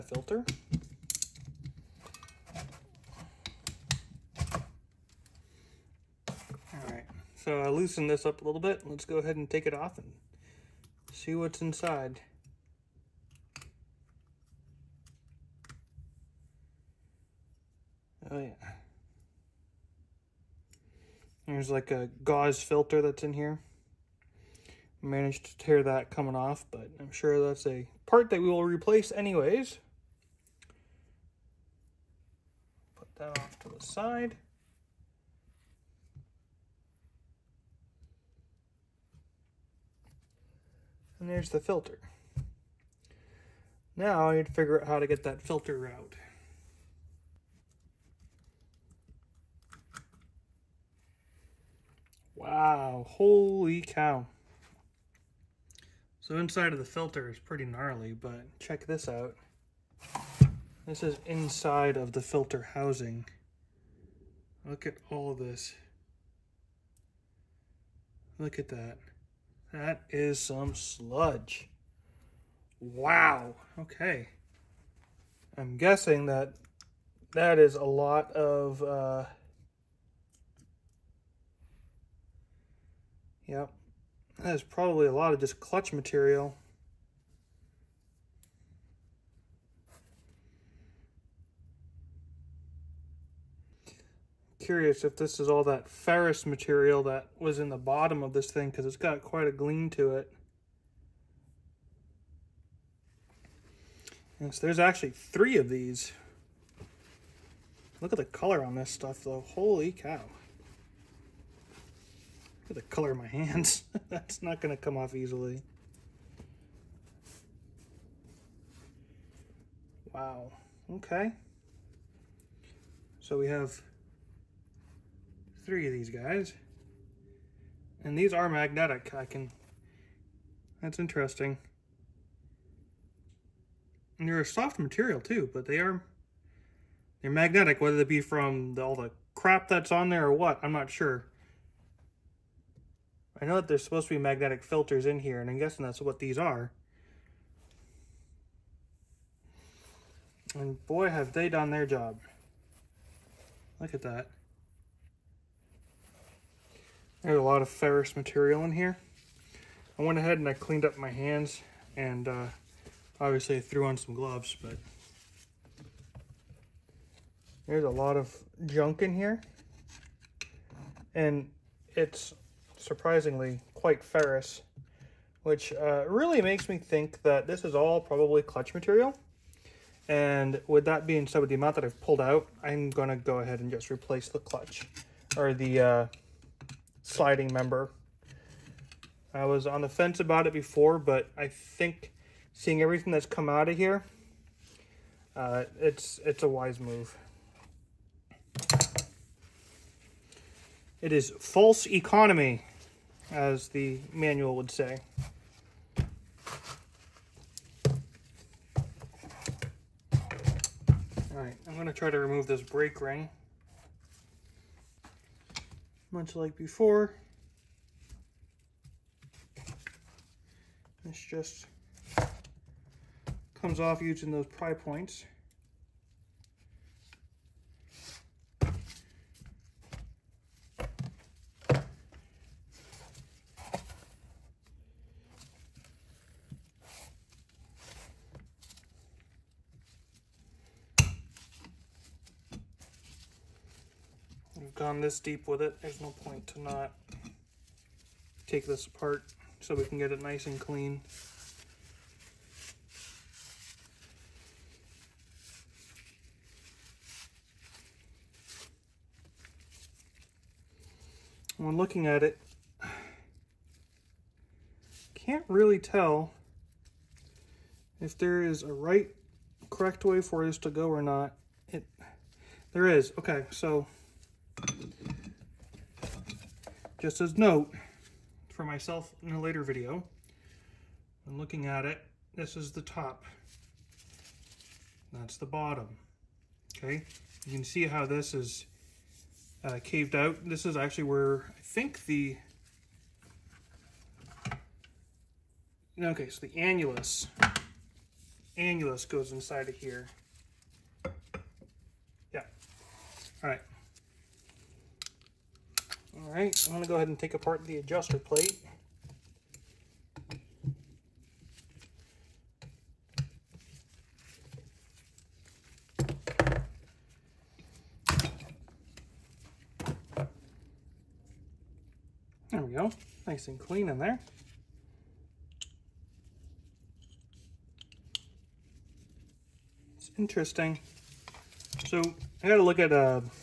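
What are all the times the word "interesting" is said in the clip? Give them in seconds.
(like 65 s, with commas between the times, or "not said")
130 s, 330 s.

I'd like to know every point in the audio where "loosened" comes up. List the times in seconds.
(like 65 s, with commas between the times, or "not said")
7 s.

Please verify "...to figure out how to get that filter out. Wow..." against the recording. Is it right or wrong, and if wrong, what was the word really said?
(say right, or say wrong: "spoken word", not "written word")
right.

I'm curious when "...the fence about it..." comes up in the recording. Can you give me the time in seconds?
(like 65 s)
189 s.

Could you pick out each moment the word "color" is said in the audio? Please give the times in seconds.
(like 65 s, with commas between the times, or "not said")
108 s, 112 s.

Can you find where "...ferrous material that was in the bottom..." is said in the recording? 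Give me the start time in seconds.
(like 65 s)
95 s.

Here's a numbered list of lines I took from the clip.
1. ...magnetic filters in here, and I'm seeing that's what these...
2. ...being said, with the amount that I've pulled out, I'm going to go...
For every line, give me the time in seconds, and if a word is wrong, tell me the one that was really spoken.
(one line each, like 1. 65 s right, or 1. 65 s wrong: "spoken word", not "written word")
1. 144 s wrong: "guessing", not "seeing"
2. 181 s right.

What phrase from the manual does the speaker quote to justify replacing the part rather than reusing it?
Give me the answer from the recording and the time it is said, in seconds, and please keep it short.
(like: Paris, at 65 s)
false economy, at 201 s.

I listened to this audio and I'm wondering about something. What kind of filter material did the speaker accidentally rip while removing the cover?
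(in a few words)
gauze filter.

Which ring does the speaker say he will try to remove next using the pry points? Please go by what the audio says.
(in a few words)
brake ring.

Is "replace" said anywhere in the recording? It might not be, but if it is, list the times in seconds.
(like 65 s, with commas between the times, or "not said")
28 s, 183 s.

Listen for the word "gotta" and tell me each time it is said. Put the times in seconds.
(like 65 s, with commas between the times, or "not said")
332 s.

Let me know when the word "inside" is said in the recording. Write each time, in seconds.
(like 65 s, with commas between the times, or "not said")
11 s, 56 s, 61 s, 299 s.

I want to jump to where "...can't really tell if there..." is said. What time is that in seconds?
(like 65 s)
265 s.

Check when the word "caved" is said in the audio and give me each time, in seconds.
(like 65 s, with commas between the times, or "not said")
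289 s.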